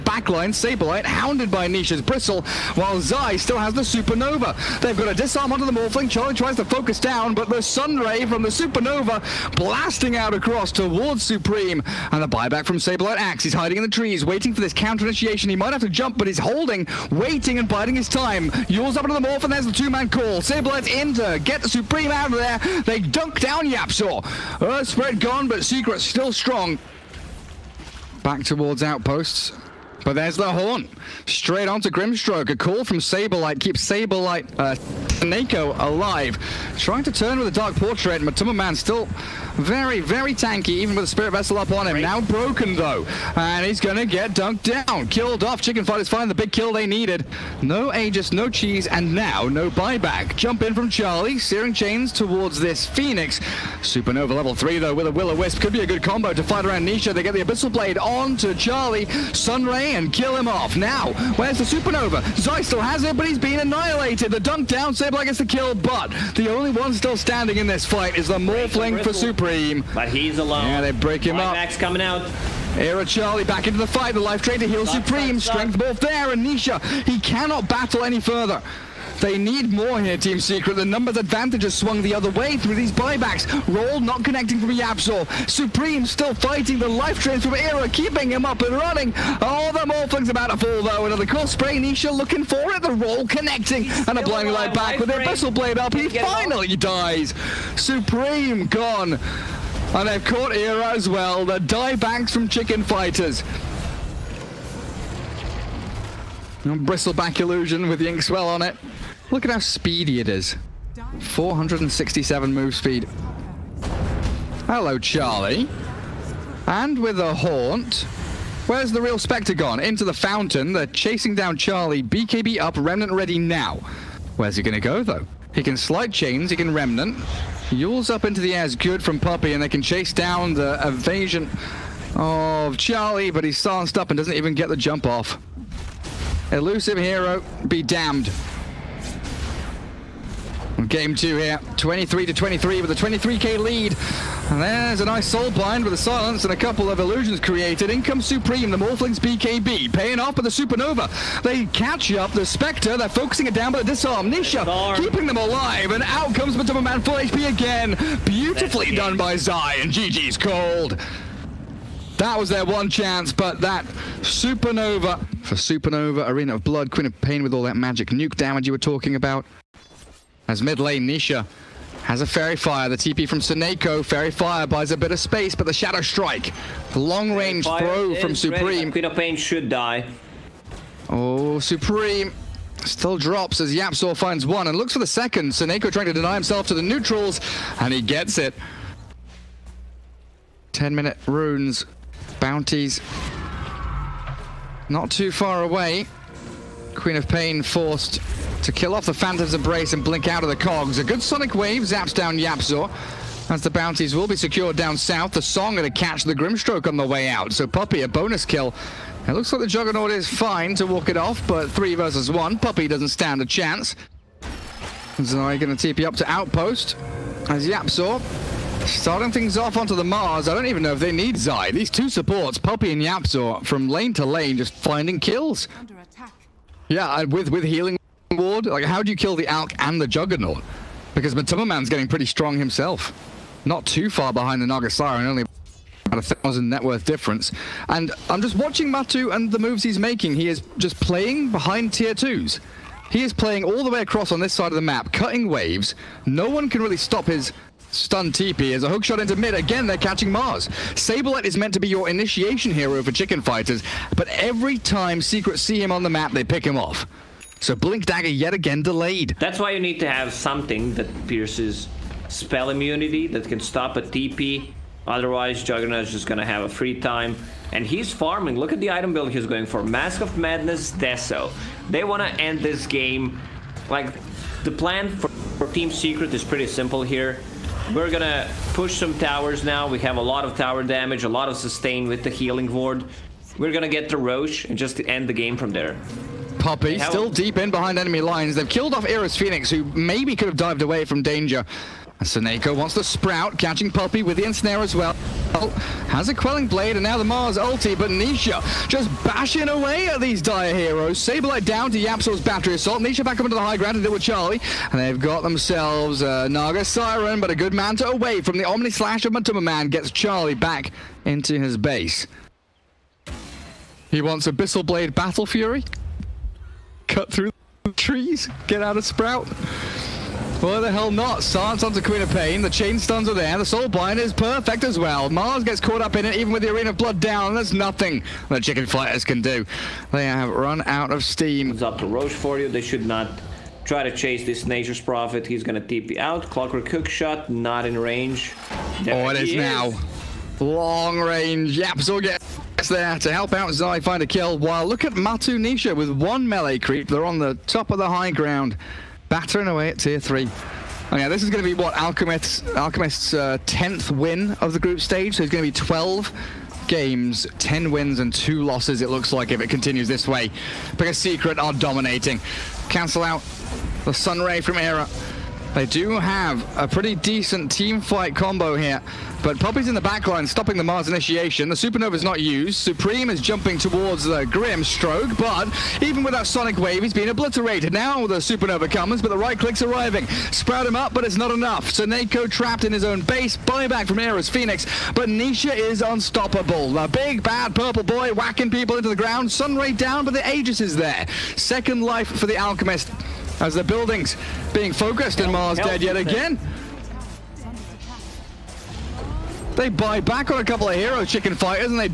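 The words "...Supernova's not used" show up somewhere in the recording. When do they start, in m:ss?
6:11.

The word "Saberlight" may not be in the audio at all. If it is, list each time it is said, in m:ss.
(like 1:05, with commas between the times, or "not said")
0:00, 0:12.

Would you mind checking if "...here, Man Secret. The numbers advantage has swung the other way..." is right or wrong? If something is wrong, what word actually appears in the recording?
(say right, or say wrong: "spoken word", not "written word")
wrong: "Team", not "Man".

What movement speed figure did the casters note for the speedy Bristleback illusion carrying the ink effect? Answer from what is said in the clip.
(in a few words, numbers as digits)
467.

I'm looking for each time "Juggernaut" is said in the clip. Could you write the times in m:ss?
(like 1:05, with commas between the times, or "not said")
3:29, 3:50, 4:25.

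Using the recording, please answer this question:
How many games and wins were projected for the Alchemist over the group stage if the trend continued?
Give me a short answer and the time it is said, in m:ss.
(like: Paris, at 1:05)
12 games, 10 wins, at 5:55.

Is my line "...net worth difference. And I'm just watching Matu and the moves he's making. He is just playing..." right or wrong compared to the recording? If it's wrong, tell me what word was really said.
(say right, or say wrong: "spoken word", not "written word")
right.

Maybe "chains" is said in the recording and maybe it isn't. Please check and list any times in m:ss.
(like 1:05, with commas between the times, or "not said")
0:51, 2:06, 5:22.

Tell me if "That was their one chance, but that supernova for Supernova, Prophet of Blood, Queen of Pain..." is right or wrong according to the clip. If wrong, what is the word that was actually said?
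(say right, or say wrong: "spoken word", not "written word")
wrong: "Arena", not "Prophet".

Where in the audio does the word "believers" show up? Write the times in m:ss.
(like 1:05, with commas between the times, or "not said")
not said.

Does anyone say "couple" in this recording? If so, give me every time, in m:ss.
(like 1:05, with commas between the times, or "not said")
2:26, 6:40.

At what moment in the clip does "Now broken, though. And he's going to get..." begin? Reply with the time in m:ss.
0:42.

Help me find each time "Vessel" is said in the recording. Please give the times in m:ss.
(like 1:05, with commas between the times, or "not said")
0:41.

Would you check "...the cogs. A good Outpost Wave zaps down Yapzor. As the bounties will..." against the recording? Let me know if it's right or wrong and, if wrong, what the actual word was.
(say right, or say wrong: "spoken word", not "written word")
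wrong: "Sonic", not "Outpost".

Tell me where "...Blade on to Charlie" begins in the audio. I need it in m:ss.
0:57.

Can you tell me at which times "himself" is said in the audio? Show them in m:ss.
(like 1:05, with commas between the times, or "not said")
3:06, 3:52.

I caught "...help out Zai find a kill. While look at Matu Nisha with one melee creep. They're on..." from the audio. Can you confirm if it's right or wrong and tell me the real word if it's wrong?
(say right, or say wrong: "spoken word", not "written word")
right.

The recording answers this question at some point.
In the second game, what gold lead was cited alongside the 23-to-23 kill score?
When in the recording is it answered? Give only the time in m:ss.
2:22.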